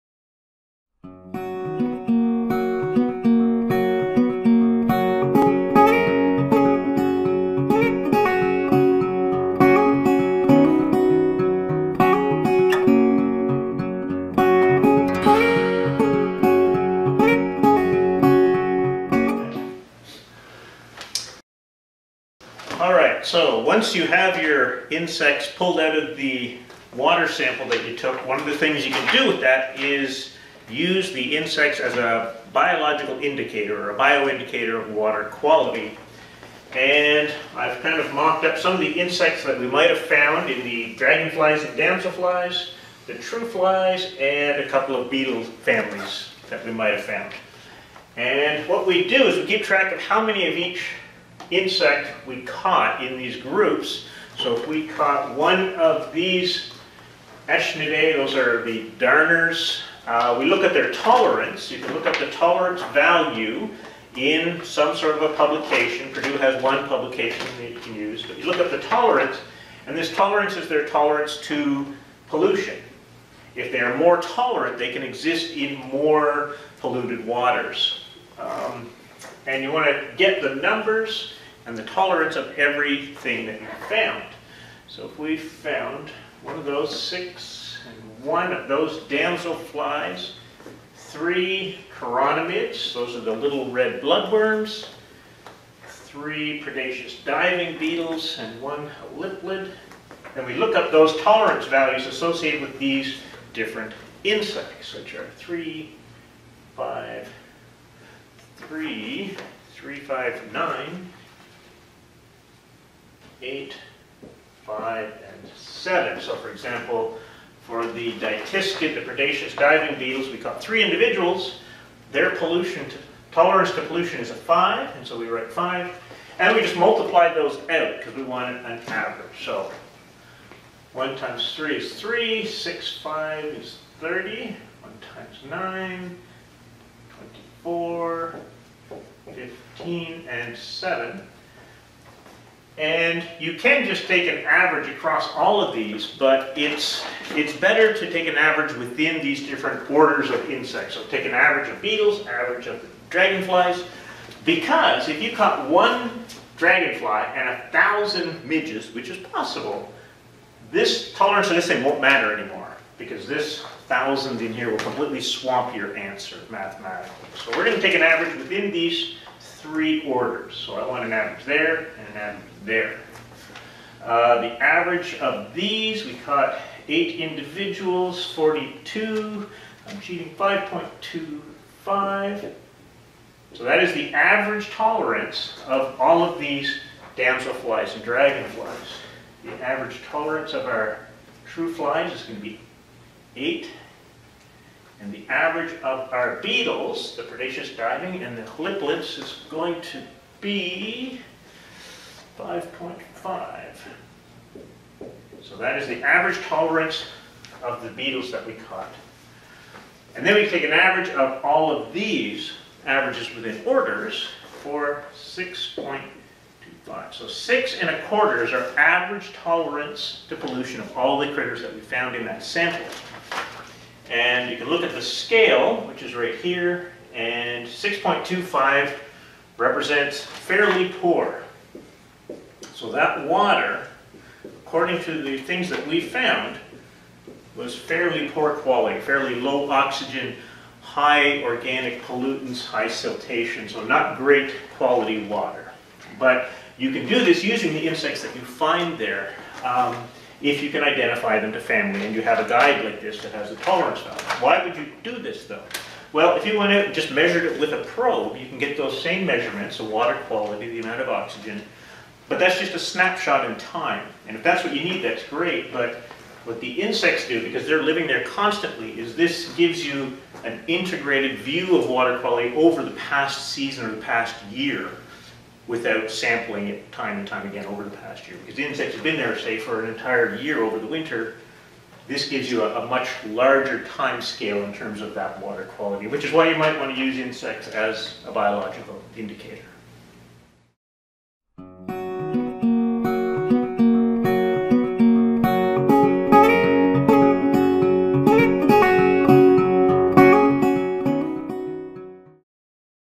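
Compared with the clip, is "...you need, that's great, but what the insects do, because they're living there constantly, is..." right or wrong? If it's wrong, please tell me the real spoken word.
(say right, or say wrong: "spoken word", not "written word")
right.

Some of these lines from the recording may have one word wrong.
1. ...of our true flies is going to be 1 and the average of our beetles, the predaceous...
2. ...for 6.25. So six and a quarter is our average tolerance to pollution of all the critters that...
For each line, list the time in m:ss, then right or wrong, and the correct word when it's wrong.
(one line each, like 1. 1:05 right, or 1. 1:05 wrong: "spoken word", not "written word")
1. 3:10 wrong: "8", not "1"
2. 3:34 right.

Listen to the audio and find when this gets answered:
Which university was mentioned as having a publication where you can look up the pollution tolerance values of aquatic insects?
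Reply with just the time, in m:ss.
1:06.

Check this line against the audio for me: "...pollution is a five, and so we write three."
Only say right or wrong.
wrong.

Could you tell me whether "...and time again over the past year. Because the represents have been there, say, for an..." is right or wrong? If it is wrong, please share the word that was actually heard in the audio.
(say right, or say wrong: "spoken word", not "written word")
wrong: "insects", not "represents".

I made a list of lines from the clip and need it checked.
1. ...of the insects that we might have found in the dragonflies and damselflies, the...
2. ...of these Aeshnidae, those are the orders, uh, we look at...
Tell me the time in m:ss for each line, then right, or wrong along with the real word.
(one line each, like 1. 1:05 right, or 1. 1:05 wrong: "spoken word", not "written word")
1. 0:38 right
2. 0:55 wrong: "darners", not "orders".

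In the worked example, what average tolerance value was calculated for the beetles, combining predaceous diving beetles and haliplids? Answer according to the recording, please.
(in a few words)
5.5.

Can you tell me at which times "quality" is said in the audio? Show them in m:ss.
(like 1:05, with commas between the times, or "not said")
0:35, 3:58, 4:04, 4:20, 4:32, 4:45.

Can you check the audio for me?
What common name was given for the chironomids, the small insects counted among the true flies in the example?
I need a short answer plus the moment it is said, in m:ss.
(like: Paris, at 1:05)
red bloodworms, at 1:33.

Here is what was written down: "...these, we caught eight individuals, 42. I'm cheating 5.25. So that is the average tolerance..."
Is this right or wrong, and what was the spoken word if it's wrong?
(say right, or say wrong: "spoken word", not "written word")
right.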